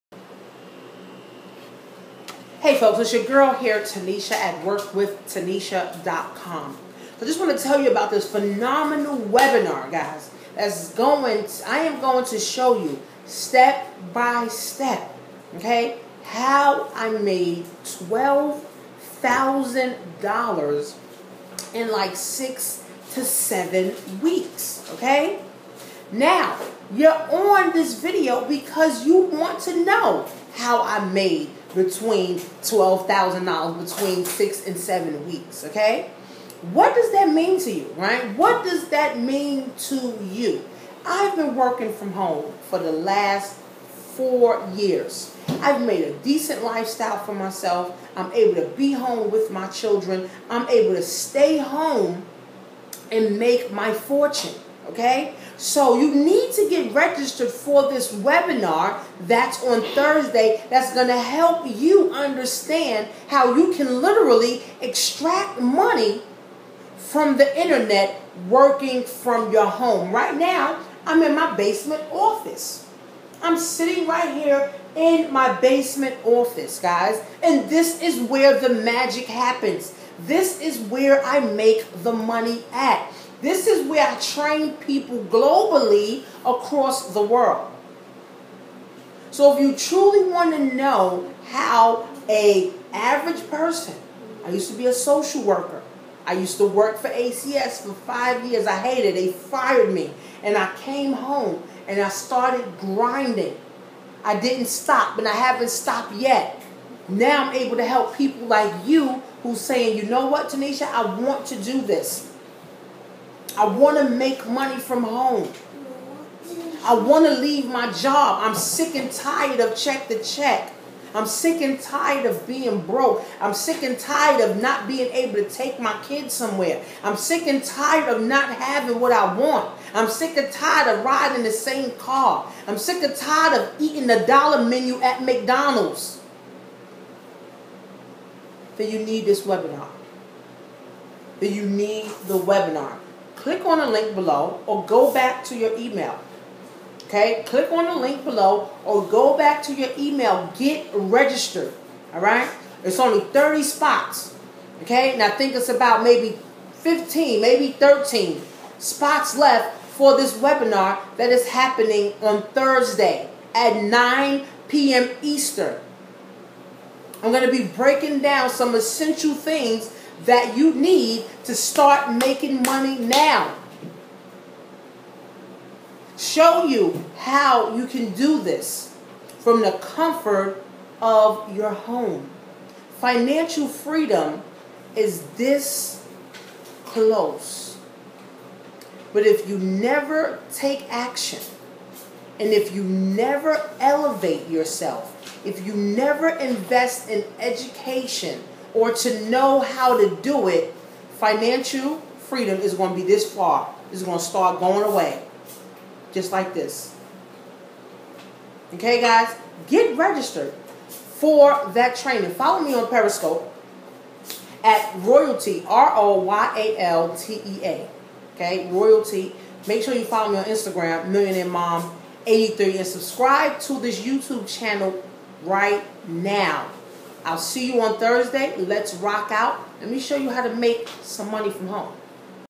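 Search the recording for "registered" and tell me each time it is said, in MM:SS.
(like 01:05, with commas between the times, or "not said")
00:56, 02:30, 03:29.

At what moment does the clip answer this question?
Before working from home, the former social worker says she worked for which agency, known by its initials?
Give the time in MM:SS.
01:37.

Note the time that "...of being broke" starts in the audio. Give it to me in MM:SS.
02:02.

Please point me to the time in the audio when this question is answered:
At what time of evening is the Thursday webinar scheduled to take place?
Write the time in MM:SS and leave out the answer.
02:43.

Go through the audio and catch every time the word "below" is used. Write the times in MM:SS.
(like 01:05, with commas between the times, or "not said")
02:24, 02:28.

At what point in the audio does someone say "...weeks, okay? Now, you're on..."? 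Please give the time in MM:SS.
00:24.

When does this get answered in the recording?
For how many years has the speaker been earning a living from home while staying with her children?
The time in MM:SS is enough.
00:43.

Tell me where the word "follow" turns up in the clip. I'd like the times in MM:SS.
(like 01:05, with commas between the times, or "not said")
03:32, 03:40.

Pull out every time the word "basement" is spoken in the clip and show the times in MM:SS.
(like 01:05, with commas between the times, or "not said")
01:11, 01:15.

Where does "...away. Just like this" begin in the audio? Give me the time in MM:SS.
03:24.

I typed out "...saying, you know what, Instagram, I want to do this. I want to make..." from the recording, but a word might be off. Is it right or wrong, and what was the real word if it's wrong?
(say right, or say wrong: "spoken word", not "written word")
wrong: "Tanisha", not "Instagram".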